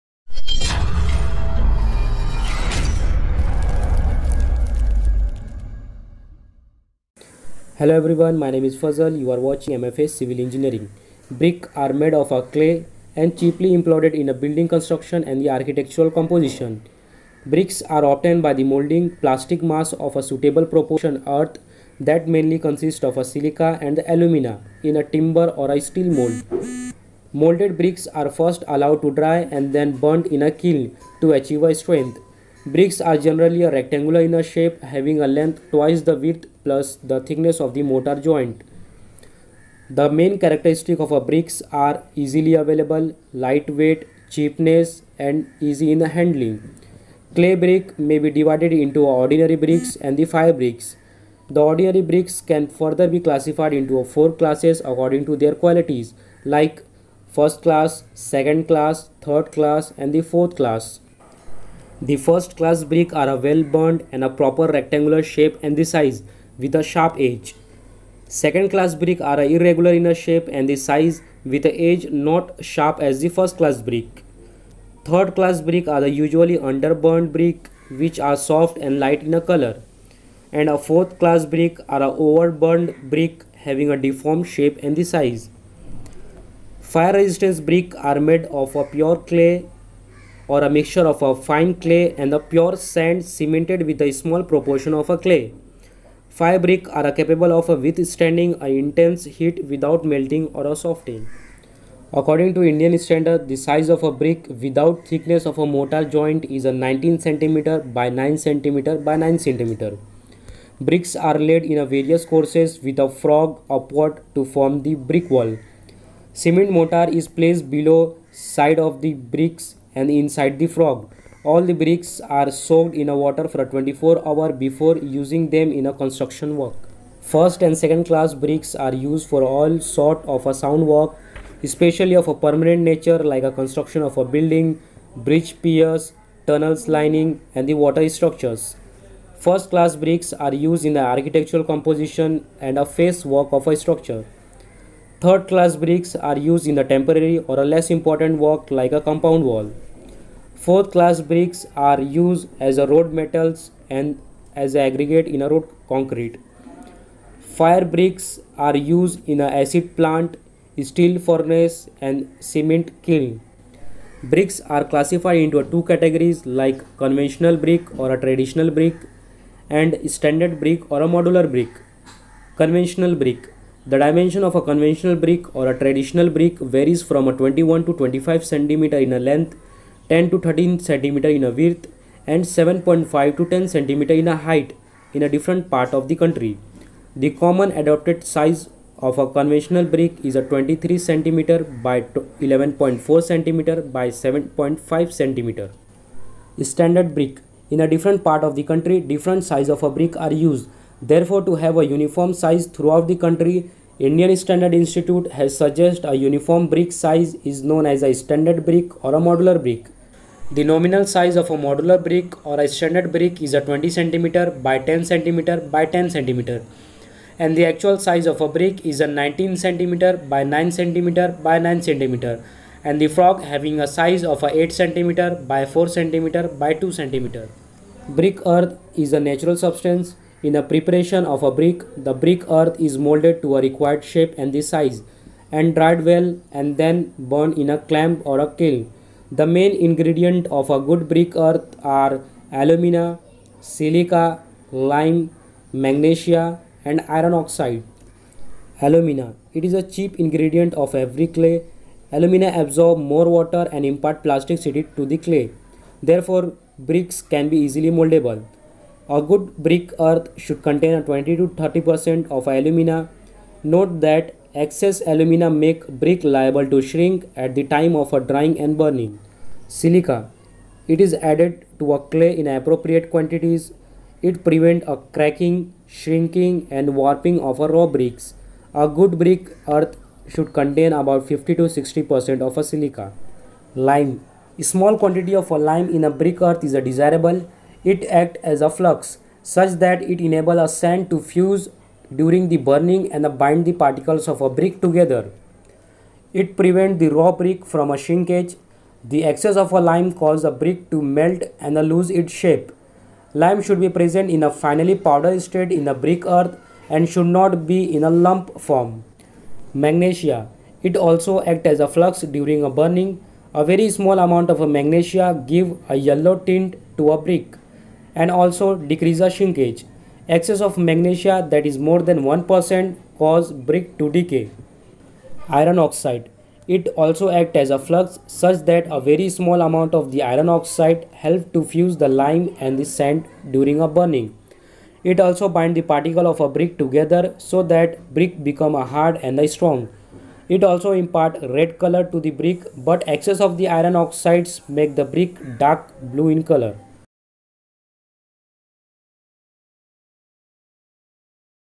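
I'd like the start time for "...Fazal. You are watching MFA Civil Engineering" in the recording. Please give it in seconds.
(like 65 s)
8 s.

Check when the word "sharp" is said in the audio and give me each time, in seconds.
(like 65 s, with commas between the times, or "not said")
66 s, 72 s.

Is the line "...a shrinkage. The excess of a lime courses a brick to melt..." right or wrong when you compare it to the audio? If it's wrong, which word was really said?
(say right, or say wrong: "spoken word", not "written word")
wrong: "causes", not "courses".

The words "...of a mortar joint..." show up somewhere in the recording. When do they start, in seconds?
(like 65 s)
105 s.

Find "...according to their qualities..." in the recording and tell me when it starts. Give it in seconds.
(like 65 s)
54 s.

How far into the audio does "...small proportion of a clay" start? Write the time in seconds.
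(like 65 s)
94 s.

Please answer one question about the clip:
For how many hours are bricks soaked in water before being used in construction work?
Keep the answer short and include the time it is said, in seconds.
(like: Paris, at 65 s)
24 hours, at 123 s.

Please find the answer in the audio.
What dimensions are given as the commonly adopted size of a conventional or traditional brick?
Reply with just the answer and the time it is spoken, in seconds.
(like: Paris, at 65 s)
23 cm by 11.4 cm by 7.5 cm, at 190 s.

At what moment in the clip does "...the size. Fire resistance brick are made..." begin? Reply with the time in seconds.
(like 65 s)
84 s.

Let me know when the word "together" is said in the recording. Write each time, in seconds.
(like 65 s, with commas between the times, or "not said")
294 s, 336 s.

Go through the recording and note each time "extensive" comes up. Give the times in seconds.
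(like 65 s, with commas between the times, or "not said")
not said.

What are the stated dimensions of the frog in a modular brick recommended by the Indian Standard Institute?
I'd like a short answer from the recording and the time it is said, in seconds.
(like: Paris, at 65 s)
8 cm by 4 cm by 2 cm, at 224 s.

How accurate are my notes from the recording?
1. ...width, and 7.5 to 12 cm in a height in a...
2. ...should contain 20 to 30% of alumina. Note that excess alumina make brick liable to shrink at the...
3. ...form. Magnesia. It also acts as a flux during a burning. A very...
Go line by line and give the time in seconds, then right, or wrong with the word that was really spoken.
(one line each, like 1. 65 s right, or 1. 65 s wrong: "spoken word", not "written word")
1. 181 s wrong: "10", not "12"
2. 260 s right
3. 308 s right.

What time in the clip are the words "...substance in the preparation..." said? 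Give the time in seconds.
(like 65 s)
229 s.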